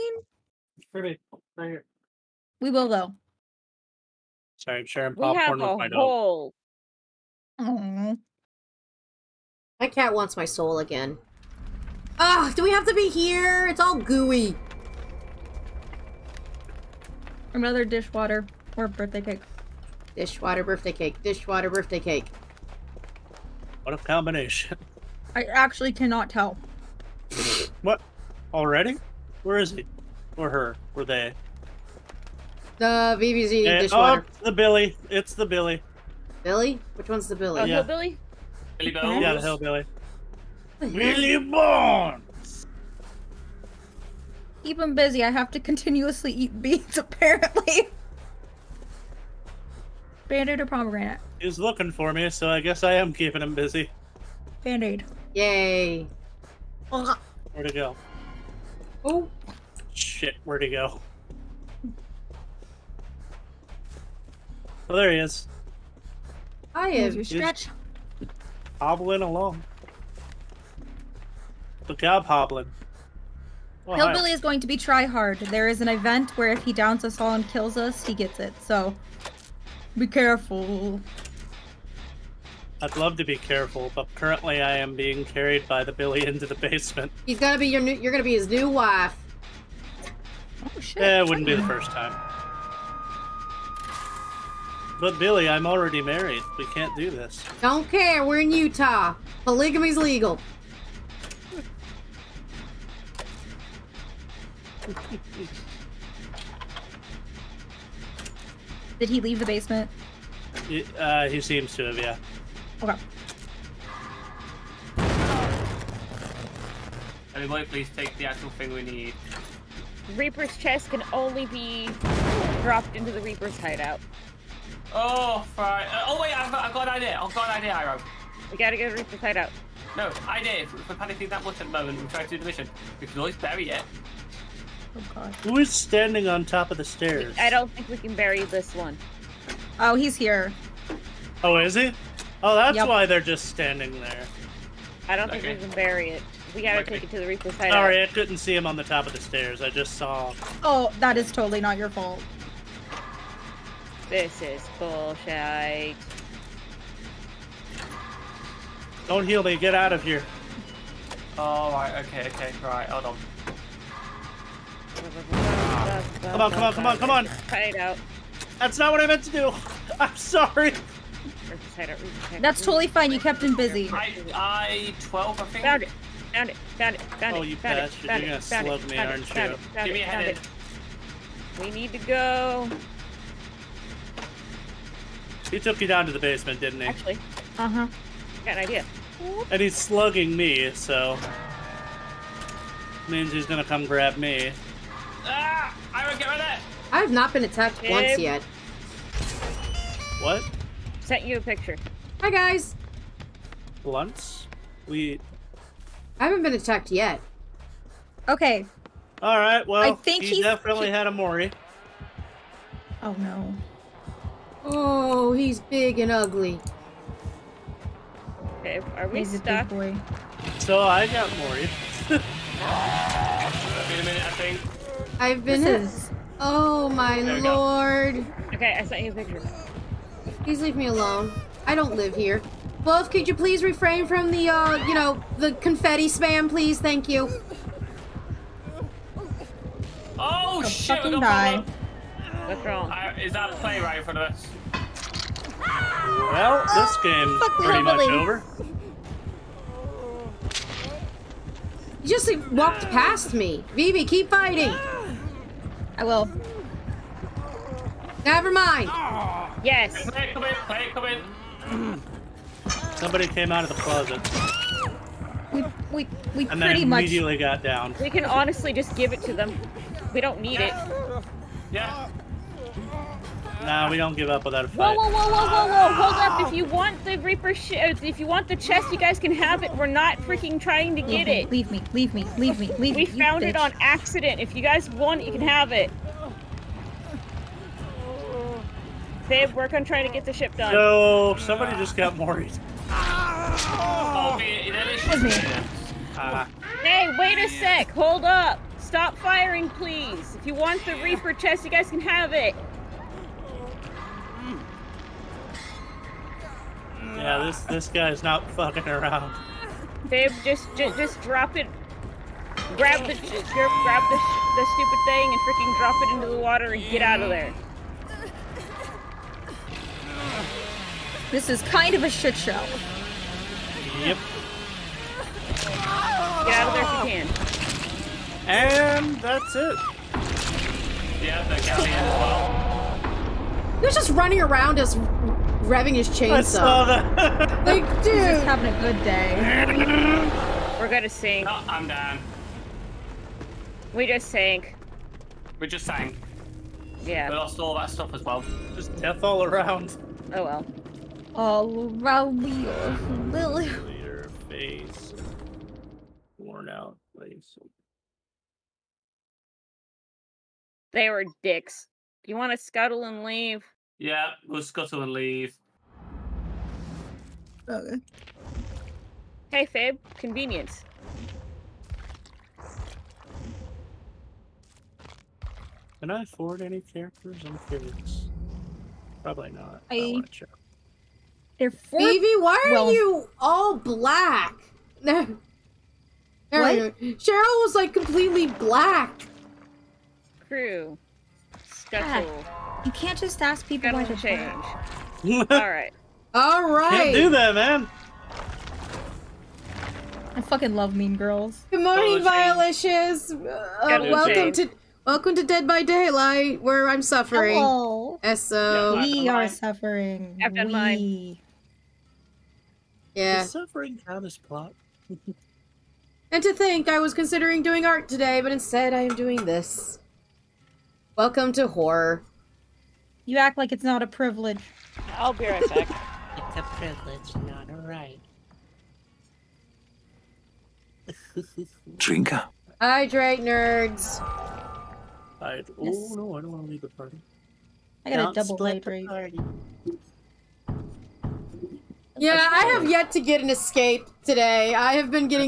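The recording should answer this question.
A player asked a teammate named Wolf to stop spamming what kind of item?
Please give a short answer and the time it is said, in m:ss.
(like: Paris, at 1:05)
confetti, at 3:55.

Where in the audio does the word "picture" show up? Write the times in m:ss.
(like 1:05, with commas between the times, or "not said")
3:21, 3:49.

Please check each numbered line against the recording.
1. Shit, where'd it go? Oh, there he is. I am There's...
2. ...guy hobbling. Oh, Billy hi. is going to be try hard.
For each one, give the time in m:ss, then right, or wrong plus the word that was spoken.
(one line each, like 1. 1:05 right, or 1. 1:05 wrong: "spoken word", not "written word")
1. 0:59 right
2. 1:11 wrong: "Hillbilly", not "Billy".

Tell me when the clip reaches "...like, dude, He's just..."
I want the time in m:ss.
5:37.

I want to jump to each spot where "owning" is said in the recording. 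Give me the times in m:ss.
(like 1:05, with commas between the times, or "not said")
not said.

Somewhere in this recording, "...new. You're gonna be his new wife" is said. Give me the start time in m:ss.
1:27.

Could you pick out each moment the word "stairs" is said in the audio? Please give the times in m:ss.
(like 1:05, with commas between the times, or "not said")
2:16, 2:29.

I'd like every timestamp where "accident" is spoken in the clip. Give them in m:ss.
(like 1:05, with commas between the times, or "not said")
4:43.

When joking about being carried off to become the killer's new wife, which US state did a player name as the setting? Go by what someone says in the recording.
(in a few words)
Utah.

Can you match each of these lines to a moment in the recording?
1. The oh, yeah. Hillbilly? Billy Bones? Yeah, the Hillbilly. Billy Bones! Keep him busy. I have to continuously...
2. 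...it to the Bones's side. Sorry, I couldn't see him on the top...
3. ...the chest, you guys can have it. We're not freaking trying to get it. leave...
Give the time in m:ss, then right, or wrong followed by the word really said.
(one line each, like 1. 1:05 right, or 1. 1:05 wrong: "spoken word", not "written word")
1. 0:37 right
2. 2:27 wrong: "Reaper", not "Bones"
3. 4:38 right.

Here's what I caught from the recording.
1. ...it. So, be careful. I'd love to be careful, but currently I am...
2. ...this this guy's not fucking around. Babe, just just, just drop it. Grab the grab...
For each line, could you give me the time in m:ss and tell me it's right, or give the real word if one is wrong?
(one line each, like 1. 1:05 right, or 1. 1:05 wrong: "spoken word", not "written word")
1. 1:18 right
2. 5:07 right.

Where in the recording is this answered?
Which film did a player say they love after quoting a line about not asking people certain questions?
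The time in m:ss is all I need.
6:40.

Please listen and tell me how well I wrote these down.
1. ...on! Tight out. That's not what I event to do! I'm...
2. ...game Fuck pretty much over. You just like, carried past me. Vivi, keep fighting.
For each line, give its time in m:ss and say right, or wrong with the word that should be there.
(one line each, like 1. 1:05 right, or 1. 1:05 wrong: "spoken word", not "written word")
1. 2:47 wrong: "meant", not "event"
2. 4:06 wrong: "walked", not "carried".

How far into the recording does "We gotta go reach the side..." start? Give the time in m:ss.
2:08.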